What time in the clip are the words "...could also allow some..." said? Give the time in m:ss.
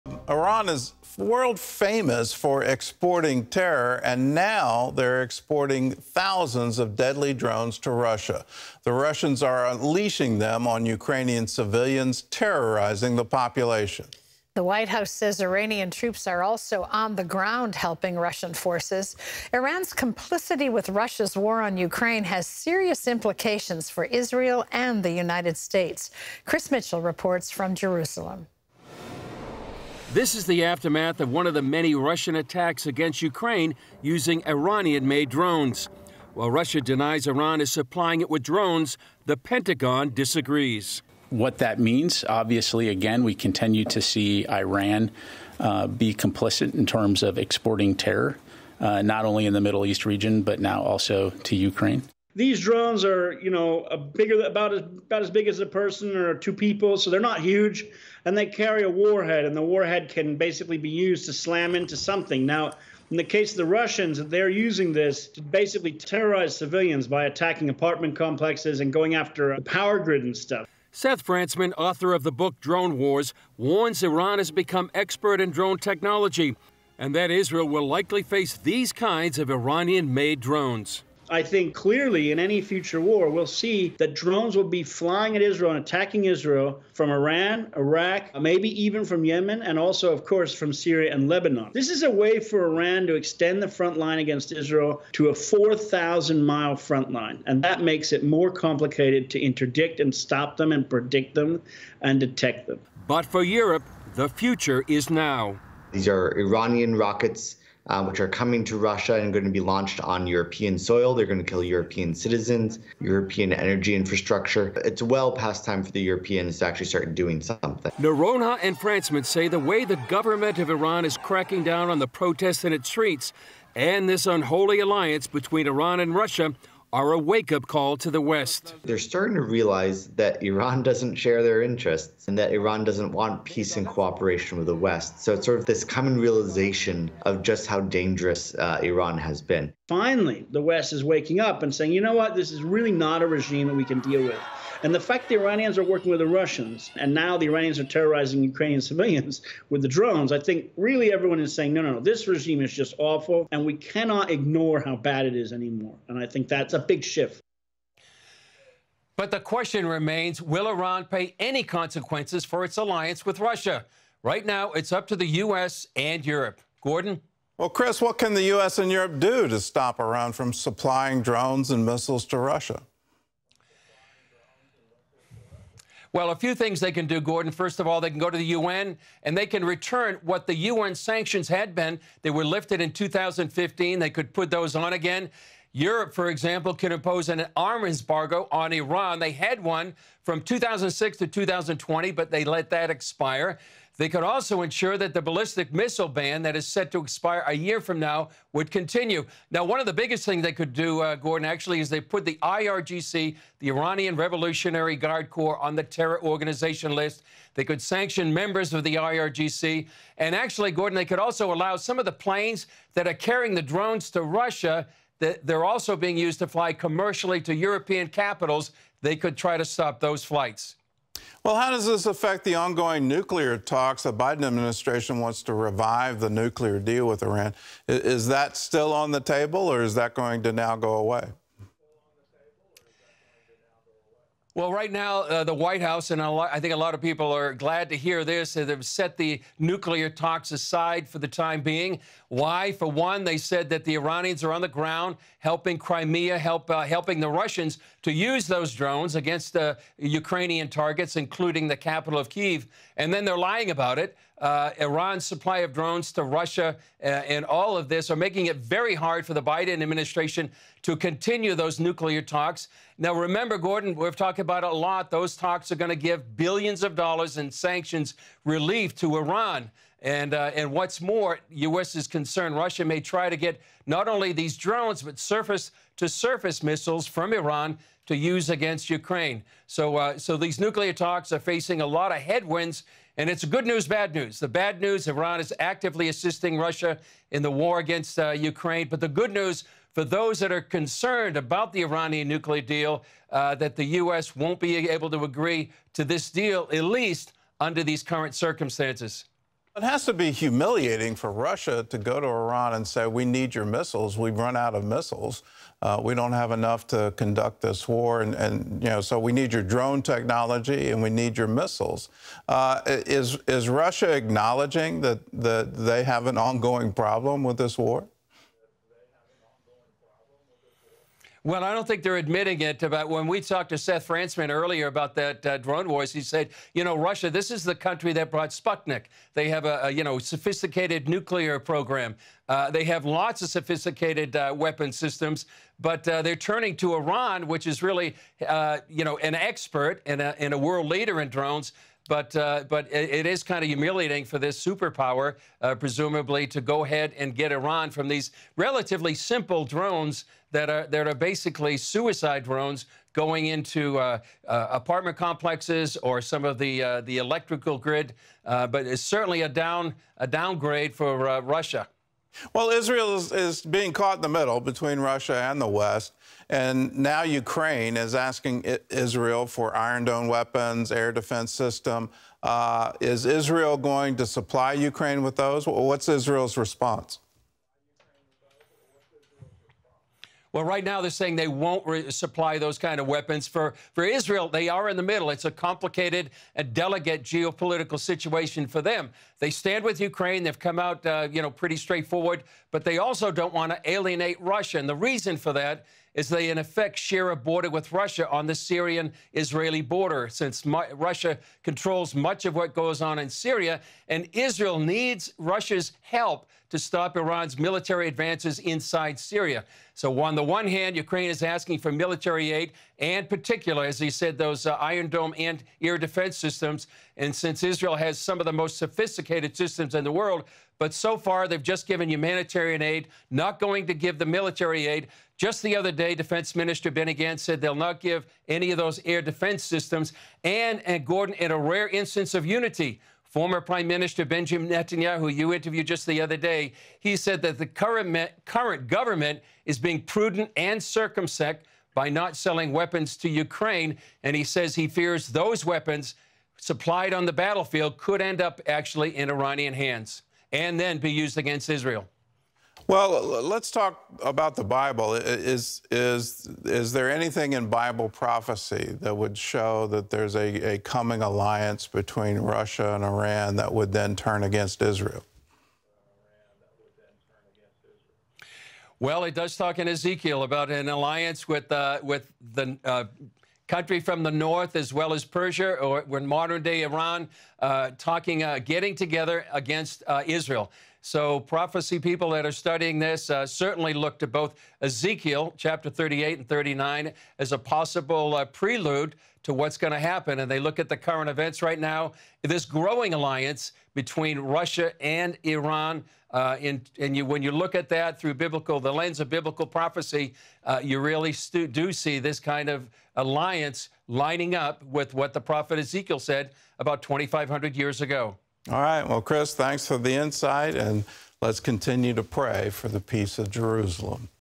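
3:31.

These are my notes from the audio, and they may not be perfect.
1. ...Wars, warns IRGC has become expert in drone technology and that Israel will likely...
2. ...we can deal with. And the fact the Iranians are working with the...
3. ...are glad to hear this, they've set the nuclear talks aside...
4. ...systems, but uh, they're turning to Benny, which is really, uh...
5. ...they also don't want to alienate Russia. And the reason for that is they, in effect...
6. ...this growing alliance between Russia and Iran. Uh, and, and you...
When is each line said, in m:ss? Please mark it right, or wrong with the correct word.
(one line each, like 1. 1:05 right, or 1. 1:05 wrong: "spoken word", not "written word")
1. 1:12 wrong: "Iran", not "IRGC"
2. 2:23 right
3. 3:57 right
4. 5:34 wrong: "Iran", not "Benny"
5. 6:32 right
6. 8:12 right.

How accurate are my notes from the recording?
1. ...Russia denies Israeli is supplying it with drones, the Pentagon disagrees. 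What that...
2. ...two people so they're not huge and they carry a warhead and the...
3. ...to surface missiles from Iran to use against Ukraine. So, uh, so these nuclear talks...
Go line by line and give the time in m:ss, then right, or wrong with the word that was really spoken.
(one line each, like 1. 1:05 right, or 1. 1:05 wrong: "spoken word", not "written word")
1. 0:36 wrong: "Iran", not "Israeli"
2. 0:56 right
3. 4:35 right.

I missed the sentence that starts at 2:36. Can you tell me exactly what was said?
And I think that's a big shift.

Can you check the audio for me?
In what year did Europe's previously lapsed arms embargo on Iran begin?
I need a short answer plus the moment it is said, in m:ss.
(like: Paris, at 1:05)
2006, at 3:10.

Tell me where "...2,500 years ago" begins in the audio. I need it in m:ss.
8:27.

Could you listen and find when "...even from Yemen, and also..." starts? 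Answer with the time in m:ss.
1:28.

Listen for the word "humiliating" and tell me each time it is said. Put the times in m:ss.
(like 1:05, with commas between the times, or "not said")
5:00, 5:43.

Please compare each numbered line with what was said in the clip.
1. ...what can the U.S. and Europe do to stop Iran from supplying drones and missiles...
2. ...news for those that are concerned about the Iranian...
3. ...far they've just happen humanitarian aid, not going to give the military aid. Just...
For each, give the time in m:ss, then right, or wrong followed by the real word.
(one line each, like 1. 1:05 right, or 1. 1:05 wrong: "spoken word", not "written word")
1. 2:48 right
2. 4:49 right
3. 7:01 wrong: "given", not "happen".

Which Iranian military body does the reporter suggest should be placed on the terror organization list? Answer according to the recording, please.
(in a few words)
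Iranian Revolutionary Guard Corps.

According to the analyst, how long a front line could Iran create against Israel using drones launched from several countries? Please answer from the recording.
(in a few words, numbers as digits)
4,000 miles.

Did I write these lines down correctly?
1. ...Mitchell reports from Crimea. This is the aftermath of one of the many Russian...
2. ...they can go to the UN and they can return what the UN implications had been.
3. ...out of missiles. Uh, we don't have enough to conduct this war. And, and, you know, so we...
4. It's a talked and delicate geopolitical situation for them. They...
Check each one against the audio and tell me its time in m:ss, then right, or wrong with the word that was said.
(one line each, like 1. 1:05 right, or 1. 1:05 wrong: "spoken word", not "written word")
1. 0:26 wrong: "Jerusalem", not "Crimea"
2. 2:58 wrong: "sanctions", not "implications"
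3. 5:04 right
4. 6:25 wrong: "complicated", not "talked".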